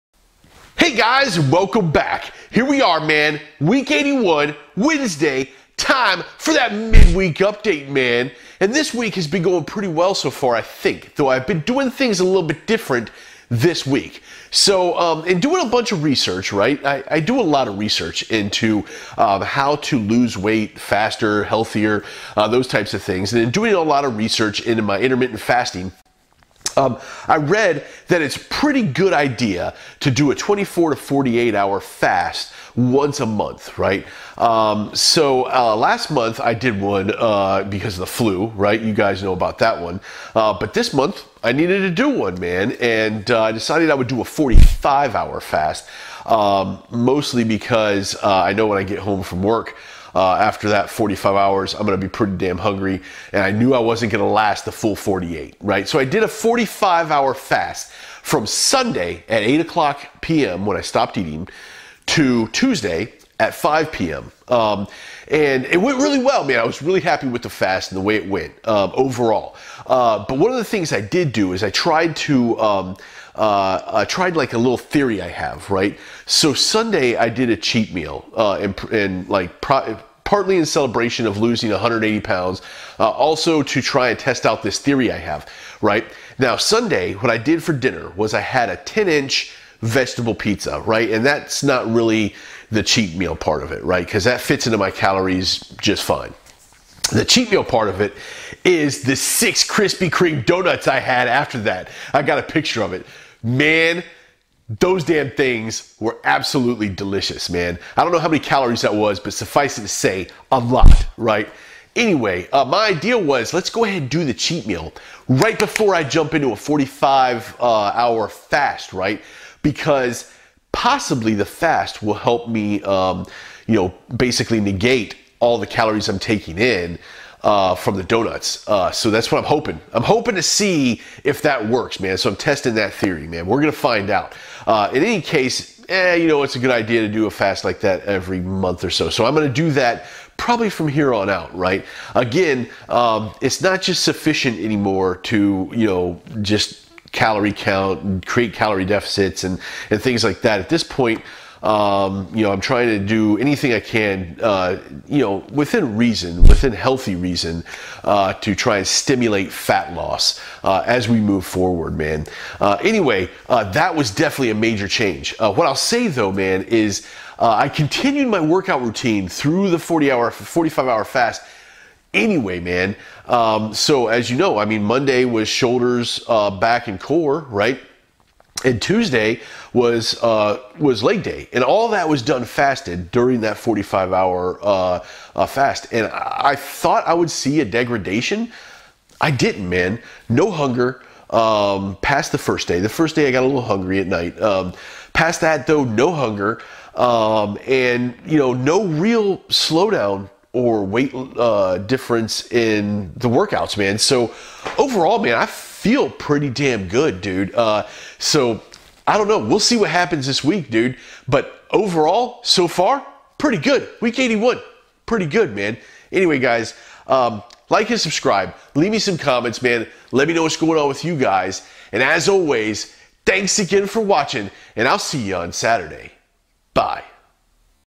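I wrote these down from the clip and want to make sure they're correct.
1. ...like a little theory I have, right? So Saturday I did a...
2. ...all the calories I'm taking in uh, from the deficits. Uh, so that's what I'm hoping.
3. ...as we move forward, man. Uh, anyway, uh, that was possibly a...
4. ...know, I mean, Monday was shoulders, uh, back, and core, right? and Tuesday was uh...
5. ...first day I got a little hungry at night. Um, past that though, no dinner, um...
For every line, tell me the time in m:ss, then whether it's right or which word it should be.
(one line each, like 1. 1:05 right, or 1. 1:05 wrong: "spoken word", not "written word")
1. 1:14 wrong: "Sunday", not "Saturday"
2. 2:05 wrong: "donuts", not "deficits"
3. 2:40 wrong: "definitely", not "possibly"
4. 2:54 right
5. 3:12 wrong: "hunger", not "dinner".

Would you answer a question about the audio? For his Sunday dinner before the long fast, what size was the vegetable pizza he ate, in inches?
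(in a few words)
10 inch.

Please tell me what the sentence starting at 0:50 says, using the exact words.
Uh, after that 45 hours, I'm going to be pretty damn hungry.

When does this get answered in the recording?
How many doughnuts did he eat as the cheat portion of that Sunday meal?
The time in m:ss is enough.
1:39.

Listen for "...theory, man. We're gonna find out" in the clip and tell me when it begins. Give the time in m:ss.
2:12.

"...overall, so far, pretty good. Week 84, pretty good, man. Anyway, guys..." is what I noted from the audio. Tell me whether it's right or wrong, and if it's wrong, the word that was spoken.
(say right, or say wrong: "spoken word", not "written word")
wrong: "81", not "84".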